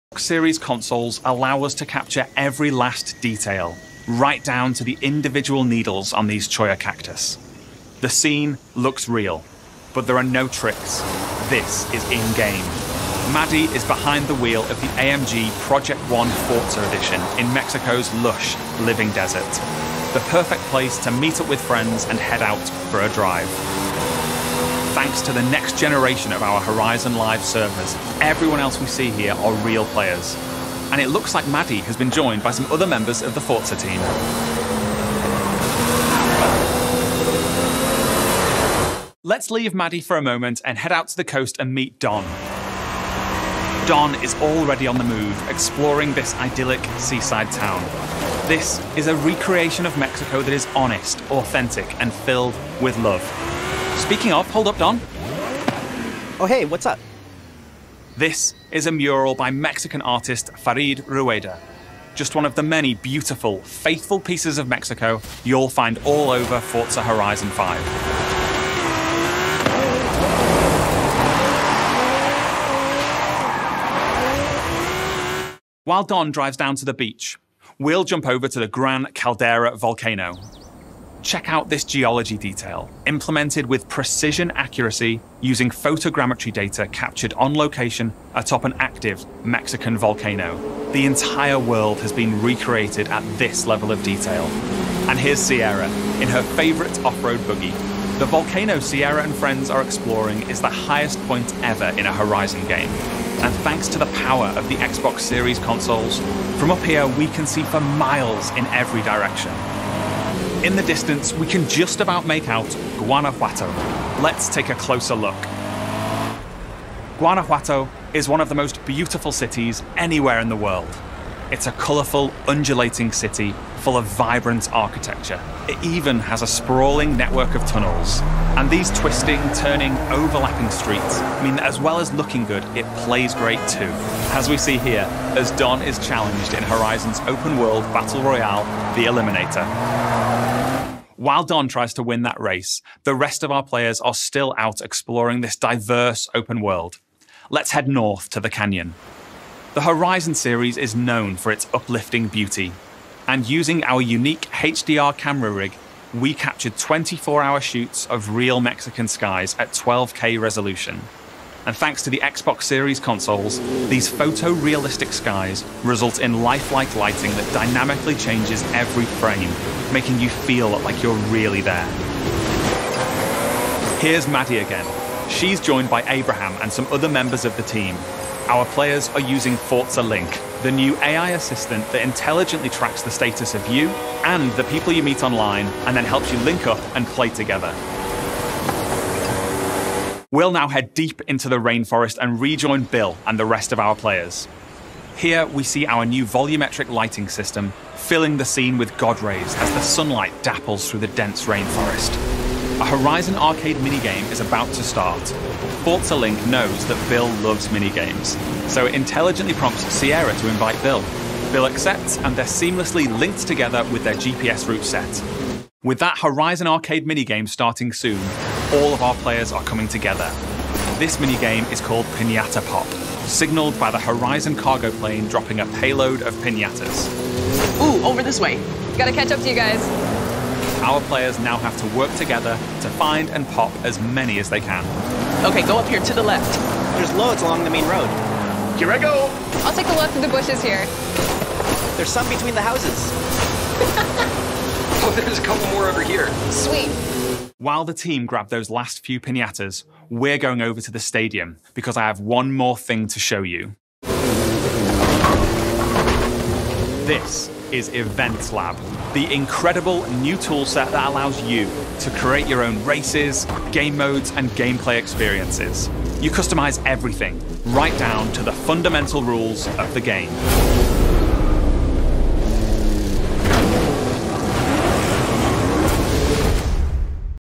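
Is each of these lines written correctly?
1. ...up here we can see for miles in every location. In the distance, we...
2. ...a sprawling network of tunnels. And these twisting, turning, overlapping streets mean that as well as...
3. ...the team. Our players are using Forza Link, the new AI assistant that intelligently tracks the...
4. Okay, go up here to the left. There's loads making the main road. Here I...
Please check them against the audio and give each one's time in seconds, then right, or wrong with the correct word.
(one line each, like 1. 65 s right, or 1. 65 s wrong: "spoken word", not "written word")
1. 106 s wrong: "direction", not "location"
2. 126 s right
3. 177 s right
4. 235 s wrong: "along", not "making".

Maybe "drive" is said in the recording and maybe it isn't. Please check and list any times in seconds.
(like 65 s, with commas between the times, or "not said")
23 s, 76 s.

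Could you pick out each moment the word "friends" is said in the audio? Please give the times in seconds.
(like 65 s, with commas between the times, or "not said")
21 s, 99 s.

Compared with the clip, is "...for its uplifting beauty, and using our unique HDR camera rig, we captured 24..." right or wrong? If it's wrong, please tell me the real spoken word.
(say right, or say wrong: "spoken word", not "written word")
right.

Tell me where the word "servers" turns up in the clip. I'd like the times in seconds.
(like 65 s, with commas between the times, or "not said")
27 s.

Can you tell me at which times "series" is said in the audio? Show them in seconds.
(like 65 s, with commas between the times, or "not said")
0 s, 105 s, 150 s, 162 s.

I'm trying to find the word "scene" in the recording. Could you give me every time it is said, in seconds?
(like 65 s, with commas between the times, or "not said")
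8 s, 198 s.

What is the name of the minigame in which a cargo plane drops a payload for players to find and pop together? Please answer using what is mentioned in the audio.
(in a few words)
Pinata Pop.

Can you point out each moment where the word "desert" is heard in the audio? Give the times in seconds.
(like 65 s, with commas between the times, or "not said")
19 s.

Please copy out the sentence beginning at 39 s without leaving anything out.
Let's leave Maddie for a moment and head out to the coast and meet Don.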